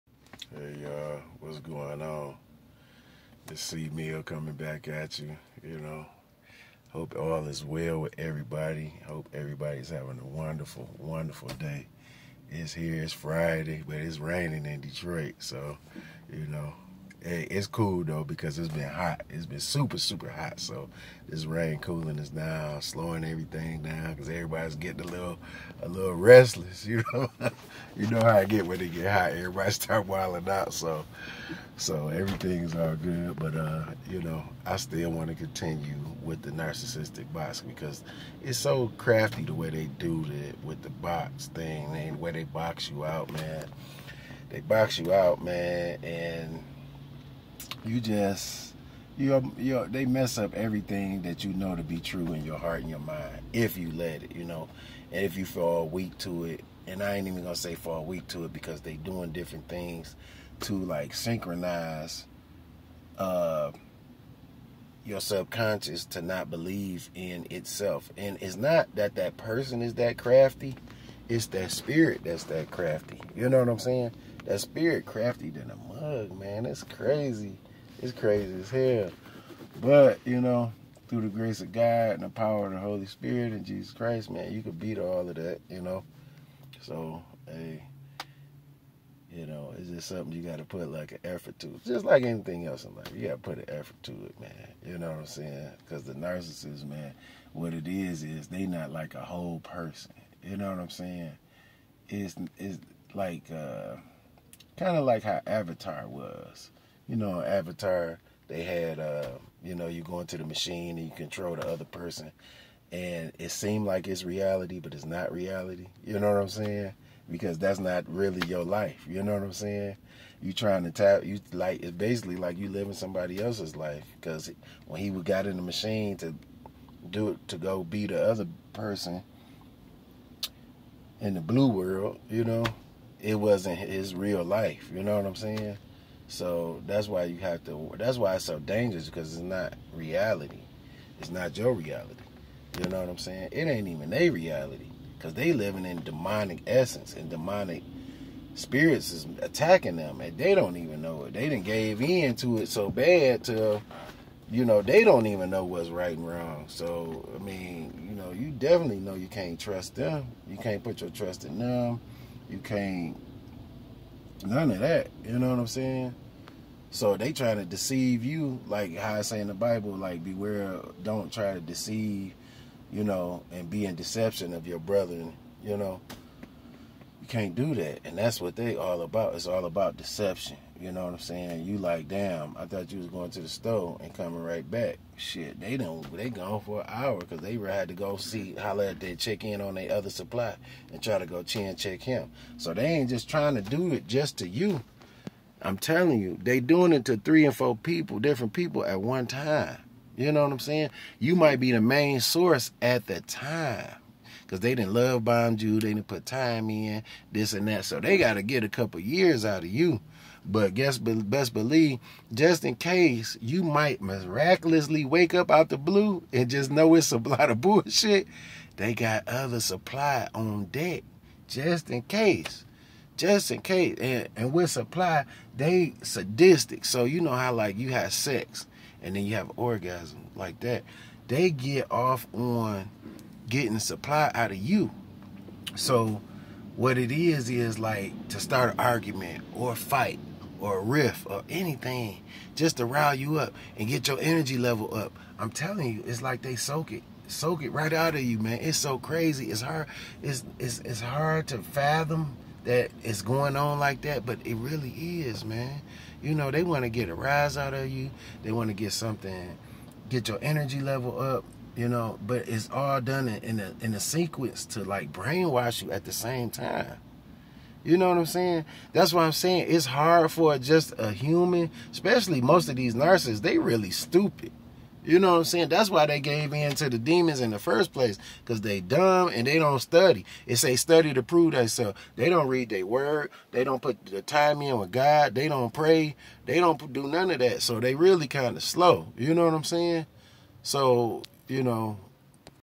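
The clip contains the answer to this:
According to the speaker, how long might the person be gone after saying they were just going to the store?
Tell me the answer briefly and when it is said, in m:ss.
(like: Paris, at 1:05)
an hour, at 3:06.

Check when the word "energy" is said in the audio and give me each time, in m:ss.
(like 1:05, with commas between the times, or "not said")
4:04, 4:20.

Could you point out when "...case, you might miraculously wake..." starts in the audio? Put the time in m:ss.
3:32.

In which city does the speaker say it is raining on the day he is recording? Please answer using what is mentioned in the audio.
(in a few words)
Detroit.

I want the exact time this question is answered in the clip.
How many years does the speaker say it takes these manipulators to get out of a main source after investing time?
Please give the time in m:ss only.
3:28.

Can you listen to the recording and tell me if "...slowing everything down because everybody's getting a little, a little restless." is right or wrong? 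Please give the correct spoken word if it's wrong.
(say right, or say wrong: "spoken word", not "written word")
right.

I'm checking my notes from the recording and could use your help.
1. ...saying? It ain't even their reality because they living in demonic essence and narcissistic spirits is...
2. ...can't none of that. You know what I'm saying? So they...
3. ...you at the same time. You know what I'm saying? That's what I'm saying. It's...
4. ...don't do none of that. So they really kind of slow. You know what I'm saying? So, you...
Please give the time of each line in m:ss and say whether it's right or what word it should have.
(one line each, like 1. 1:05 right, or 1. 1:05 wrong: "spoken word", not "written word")
1. 2:23 wrong: "demonic", not "narcissistic"
2. 2:42 right
3. 4:25 right
4. 4:46 right.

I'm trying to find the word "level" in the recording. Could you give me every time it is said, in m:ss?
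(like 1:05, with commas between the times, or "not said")
4:04, 4:20.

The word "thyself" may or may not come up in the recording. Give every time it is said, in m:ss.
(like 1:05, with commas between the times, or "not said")
4:41.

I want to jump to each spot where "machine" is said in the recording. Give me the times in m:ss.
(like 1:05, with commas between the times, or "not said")
1:50, 2:05.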